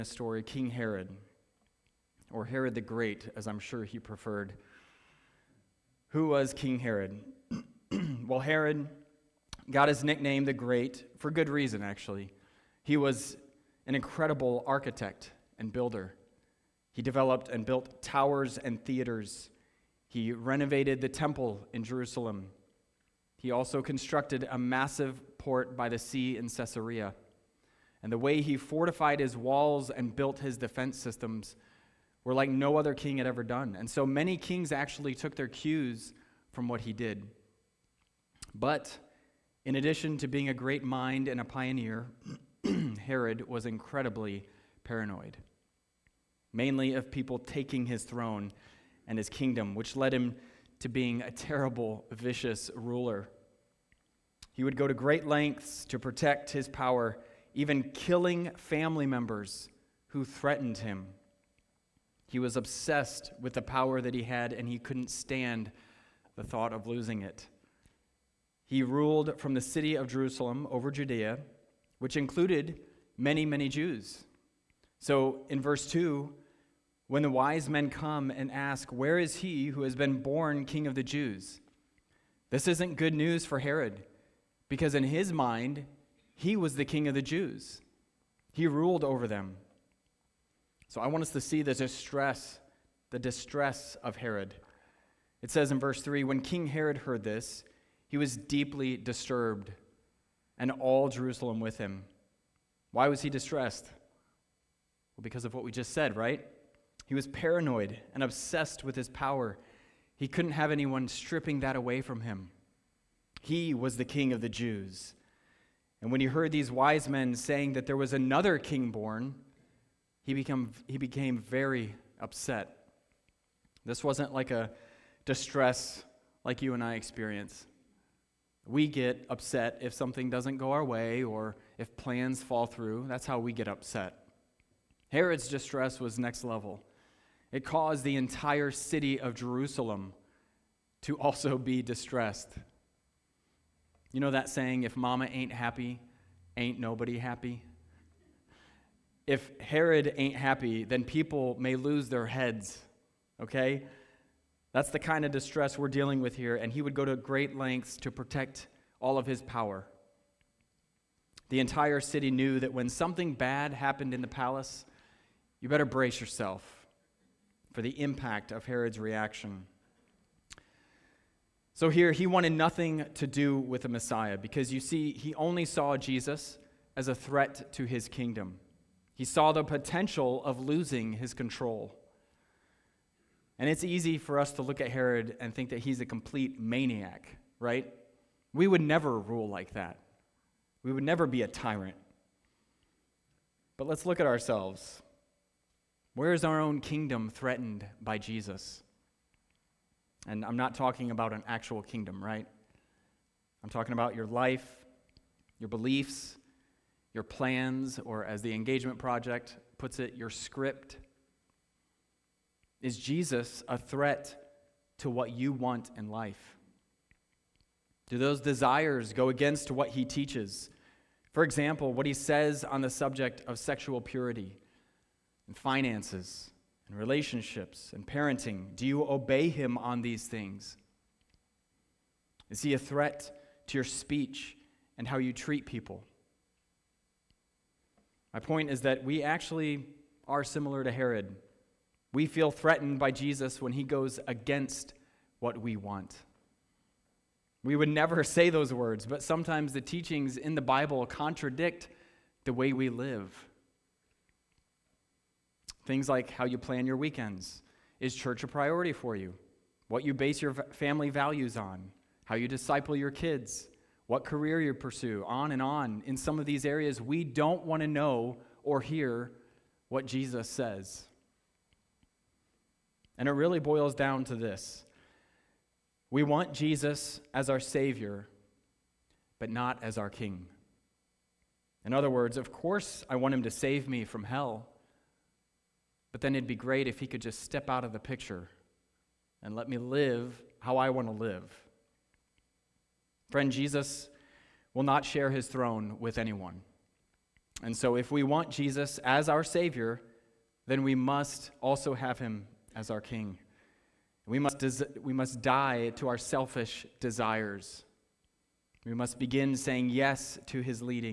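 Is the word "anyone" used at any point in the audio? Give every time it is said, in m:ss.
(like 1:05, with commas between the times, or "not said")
1:50, 4:56.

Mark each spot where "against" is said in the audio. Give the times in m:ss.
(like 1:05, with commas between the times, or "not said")
3:39, 4:04.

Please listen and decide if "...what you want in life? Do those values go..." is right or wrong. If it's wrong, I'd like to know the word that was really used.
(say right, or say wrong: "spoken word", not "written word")
wrong: "desires", not "values".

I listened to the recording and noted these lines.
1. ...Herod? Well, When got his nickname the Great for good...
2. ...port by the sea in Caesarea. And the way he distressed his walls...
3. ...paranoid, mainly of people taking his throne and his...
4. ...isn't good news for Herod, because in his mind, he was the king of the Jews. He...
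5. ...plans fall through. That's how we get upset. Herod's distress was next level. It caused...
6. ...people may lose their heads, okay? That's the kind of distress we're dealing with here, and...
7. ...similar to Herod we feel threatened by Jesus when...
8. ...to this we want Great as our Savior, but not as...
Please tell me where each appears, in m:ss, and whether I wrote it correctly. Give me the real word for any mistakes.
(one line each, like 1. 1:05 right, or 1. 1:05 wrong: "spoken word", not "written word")
1. 0:06 wrong: "Herod", not "When"
2. 0:25 wrong: "fortified", not "distressed"
3. 0:44 right
4. 1:22 right
5. 2:11 right
6. 2:31 right
7. 4:00 right
8. 4:34 wrong: "Jesus", not "Great".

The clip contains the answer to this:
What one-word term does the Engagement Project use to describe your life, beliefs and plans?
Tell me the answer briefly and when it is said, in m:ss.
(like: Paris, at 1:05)
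script, at 3:30.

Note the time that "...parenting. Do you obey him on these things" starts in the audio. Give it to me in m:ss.
3:48.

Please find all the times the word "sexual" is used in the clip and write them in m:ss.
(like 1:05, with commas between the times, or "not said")
3:43.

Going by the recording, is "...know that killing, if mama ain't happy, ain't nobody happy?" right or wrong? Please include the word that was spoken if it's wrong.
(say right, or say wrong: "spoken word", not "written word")
wrong: "saying", not "killing".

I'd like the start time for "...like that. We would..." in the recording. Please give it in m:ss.
3:09.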